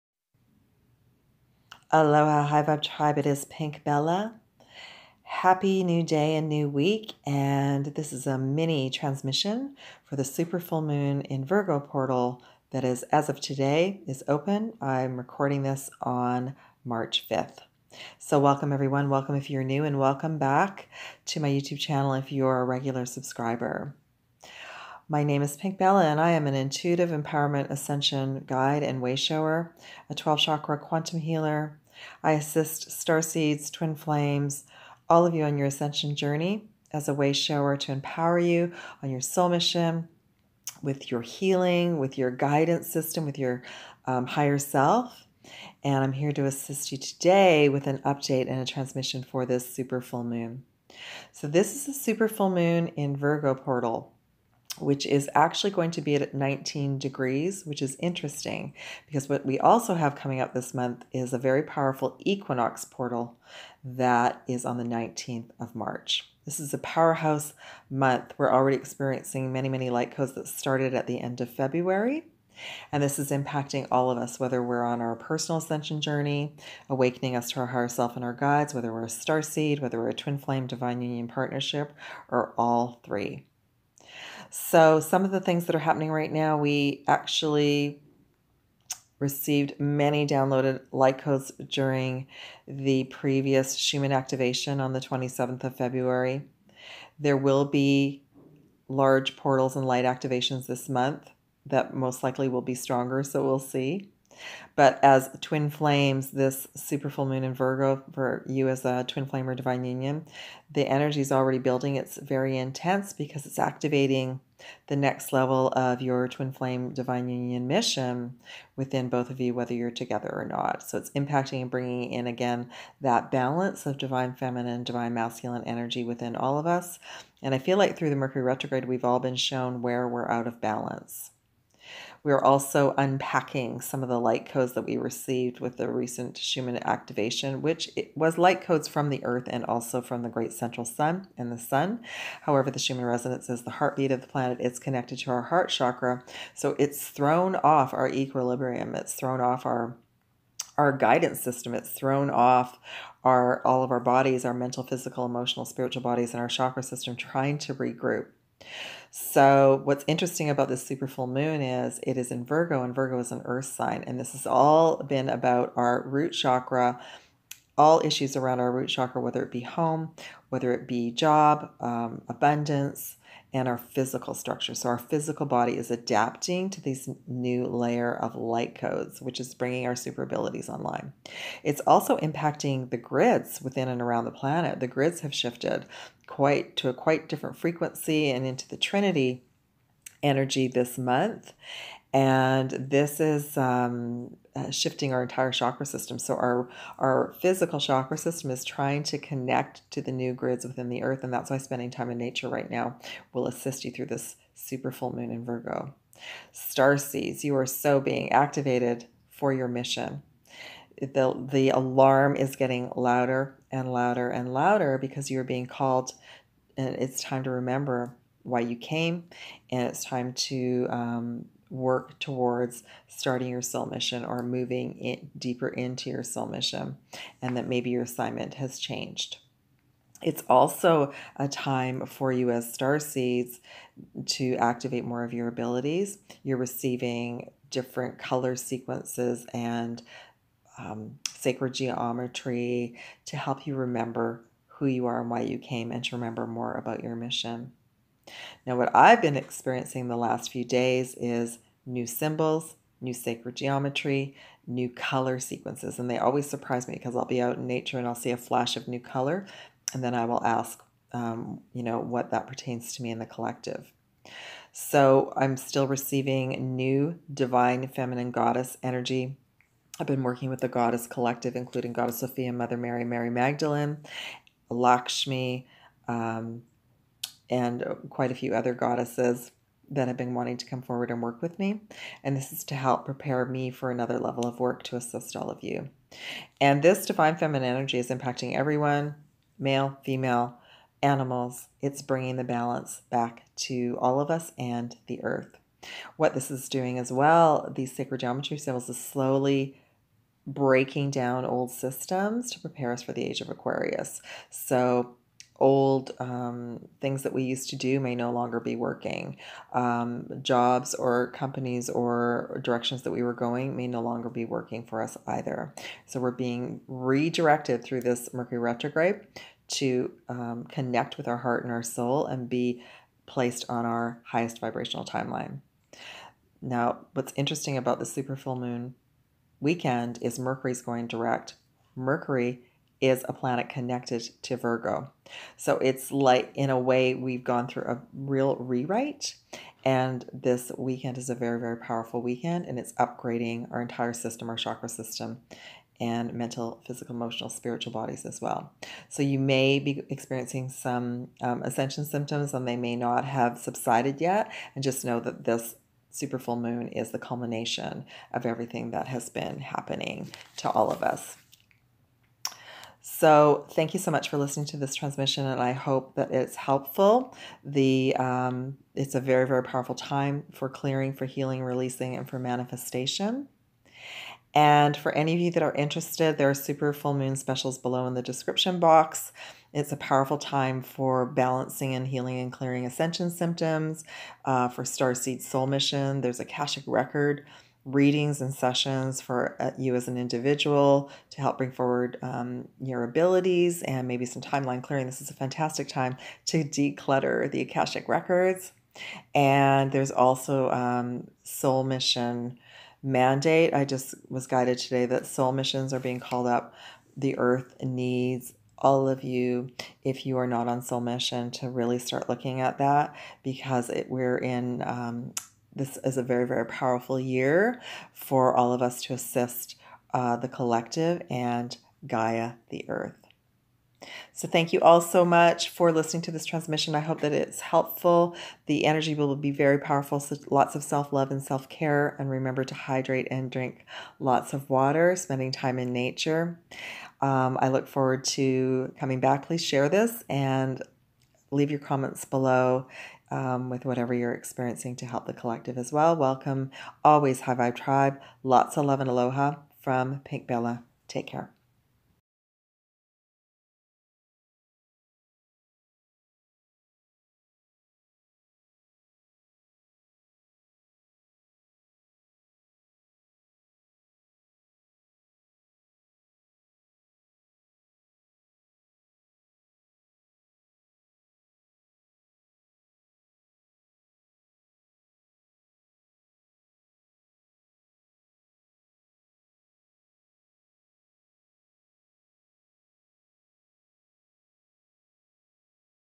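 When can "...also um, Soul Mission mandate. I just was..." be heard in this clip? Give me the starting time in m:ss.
6:40.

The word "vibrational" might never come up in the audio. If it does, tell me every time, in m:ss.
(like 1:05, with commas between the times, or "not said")
5:24.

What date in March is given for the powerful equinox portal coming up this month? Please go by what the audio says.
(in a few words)
19th of March.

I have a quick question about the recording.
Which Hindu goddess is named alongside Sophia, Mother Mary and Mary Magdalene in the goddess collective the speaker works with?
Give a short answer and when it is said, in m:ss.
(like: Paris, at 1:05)
Lakshmi, at 4:34.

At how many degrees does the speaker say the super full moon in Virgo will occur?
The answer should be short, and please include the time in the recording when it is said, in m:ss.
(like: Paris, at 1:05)
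19 degrees, at 0:56.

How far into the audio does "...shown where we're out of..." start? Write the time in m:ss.
2:09.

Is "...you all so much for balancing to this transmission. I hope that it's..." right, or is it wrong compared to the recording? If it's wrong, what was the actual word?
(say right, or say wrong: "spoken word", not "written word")
wrong: "listening", not "balancing".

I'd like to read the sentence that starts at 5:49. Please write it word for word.
So you may be experiencing some um, ascension symptoms, and they may not have subsided yet.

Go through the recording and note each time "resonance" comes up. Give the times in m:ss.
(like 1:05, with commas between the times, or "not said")
2:23.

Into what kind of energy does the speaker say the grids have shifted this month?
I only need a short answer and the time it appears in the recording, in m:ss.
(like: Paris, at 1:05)
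Trinity energy, at 3:08.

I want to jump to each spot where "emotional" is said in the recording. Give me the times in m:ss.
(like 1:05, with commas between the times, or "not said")
2:35, 5:47.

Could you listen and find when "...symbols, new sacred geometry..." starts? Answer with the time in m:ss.
4:12.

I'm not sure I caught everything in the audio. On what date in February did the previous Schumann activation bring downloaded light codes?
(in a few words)
27th of February.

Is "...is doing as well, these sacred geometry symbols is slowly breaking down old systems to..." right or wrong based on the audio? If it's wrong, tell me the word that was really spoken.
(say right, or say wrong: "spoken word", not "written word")
right.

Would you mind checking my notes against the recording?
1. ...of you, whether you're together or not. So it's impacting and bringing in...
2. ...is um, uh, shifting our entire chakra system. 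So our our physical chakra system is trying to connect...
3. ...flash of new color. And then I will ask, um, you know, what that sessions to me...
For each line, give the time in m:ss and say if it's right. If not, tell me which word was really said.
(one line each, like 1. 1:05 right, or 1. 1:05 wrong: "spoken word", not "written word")
1. 1:59 right
2. 3:13 right
3. 4:18 wrong: "pertains", not "sessions".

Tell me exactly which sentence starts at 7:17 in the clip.
Um, I look forward to coming back.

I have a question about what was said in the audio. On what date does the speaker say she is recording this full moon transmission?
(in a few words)
March 5th.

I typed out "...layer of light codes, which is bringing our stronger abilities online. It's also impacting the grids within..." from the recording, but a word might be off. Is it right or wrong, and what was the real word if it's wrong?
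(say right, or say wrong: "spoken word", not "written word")
wrong: "super", not "stronger".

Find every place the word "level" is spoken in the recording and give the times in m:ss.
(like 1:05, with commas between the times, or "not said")
1:55, 4:44.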